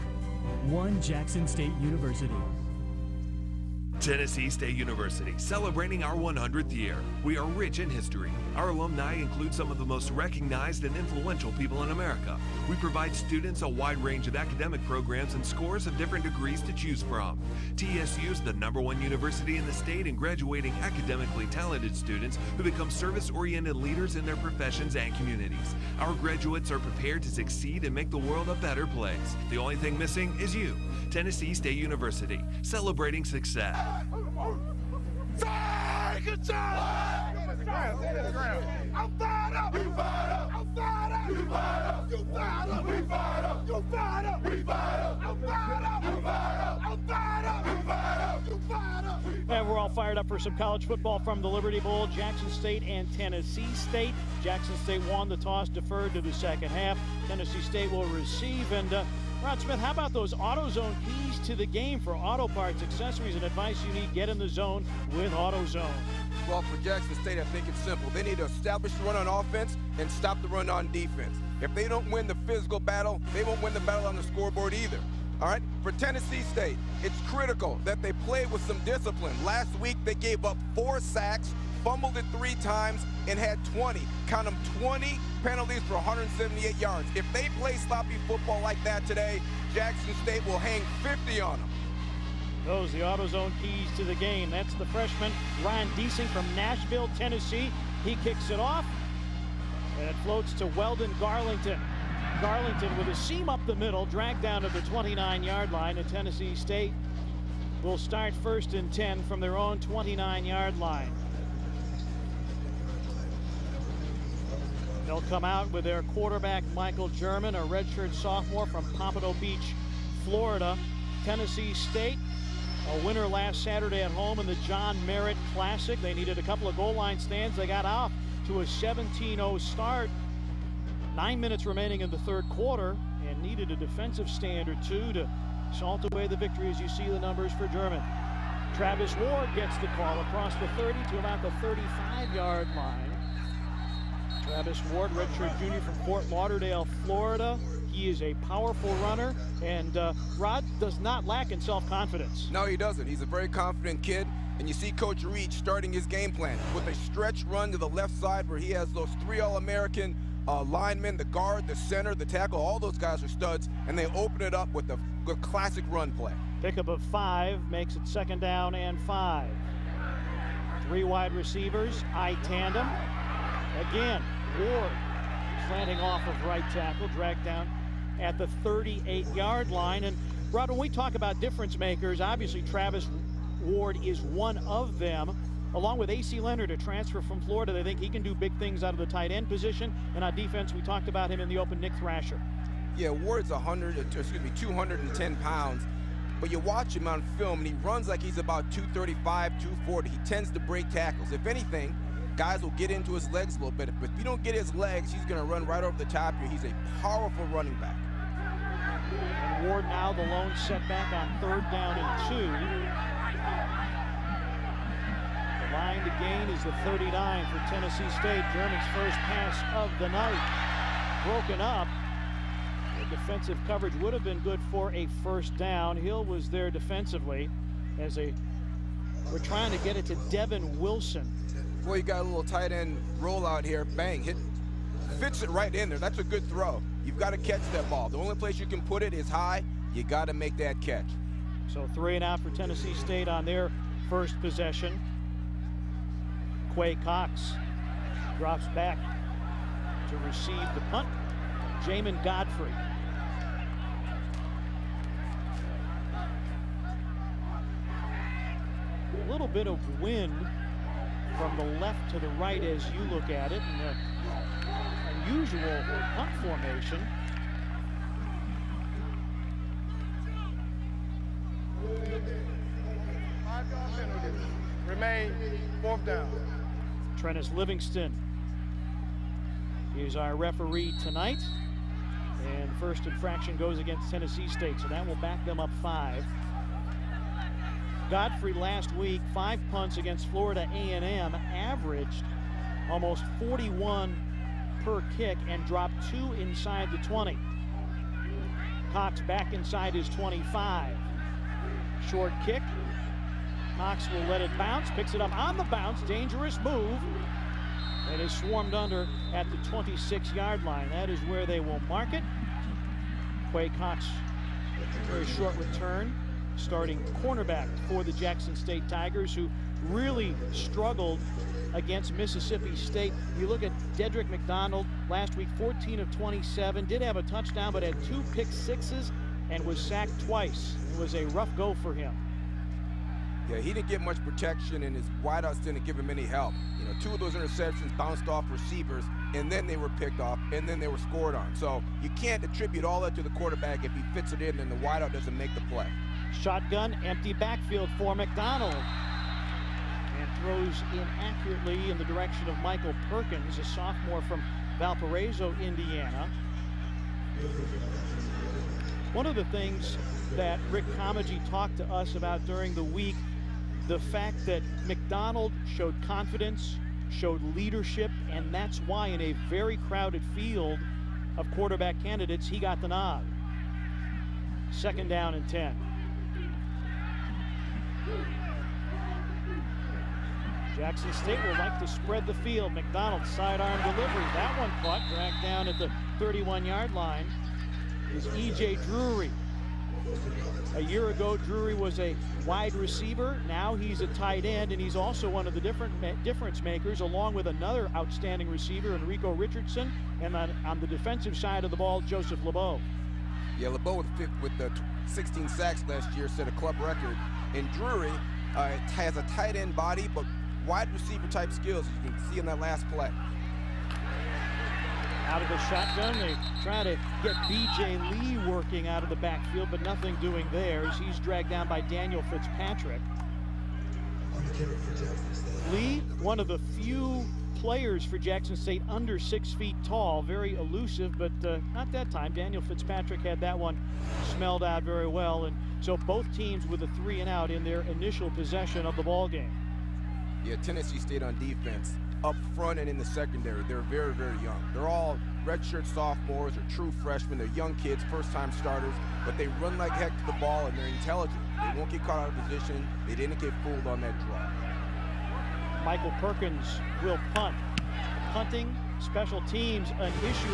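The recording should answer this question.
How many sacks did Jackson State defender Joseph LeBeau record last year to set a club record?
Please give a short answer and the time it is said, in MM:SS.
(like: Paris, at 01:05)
16, at 06:45.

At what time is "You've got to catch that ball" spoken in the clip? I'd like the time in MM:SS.
03:57.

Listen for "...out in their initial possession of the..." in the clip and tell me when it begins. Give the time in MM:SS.
07:17.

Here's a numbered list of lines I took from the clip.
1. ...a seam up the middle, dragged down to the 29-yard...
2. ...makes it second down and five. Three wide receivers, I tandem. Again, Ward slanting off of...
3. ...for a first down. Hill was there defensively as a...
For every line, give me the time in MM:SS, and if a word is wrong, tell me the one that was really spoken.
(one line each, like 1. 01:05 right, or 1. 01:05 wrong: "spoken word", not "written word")
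1. 01:43 right
2. 02:47 right
3. 03:44 right.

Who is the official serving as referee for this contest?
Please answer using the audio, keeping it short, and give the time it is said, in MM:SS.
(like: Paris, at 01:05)
Trennis Livingston, at 04:37.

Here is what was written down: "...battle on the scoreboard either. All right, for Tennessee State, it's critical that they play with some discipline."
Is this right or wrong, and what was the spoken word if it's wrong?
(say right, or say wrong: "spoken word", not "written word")
right.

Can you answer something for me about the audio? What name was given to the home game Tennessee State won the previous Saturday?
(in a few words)
John Merritt Classic.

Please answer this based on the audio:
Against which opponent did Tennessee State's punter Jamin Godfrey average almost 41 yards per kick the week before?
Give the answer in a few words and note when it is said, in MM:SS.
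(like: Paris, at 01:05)
Florida A&M, at 04:50.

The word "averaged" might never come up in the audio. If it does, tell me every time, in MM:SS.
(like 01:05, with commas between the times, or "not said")
04:51.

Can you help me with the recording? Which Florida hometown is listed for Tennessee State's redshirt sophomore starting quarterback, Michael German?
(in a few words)
Pompano Beach.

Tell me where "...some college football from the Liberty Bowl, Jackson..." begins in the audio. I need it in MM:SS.
00:50.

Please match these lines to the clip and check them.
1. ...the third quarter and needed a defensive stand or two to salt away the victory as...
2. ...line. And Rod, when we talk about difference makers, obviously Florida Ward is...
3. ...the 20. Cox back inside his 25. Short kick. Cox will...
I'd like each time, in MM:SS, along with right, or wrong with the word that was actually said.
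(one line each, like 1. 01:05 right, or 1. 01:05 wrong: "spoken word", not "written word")
1. 02:12 right
2. 02:59 wrong: "Travis", not "Florida"
3. 04:56 right.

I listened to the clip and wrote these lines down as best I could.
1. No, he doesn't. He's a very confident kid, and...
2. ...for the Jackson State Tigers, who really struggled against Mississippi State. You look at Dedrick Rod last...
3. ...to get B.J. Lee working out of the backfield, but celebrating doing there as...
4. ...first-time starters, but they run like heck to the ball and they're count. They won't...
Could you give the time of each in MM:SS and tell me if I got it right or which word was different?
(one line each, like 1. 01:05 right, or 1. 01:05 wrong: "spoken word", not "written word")
1. 02:32 right
2. 05:17 wrong: "McDonald", not "Rod"
3. 06:56 wrong: "nothing", not "celebrating"
4. 07:28 wrong: "intelligent", not "count".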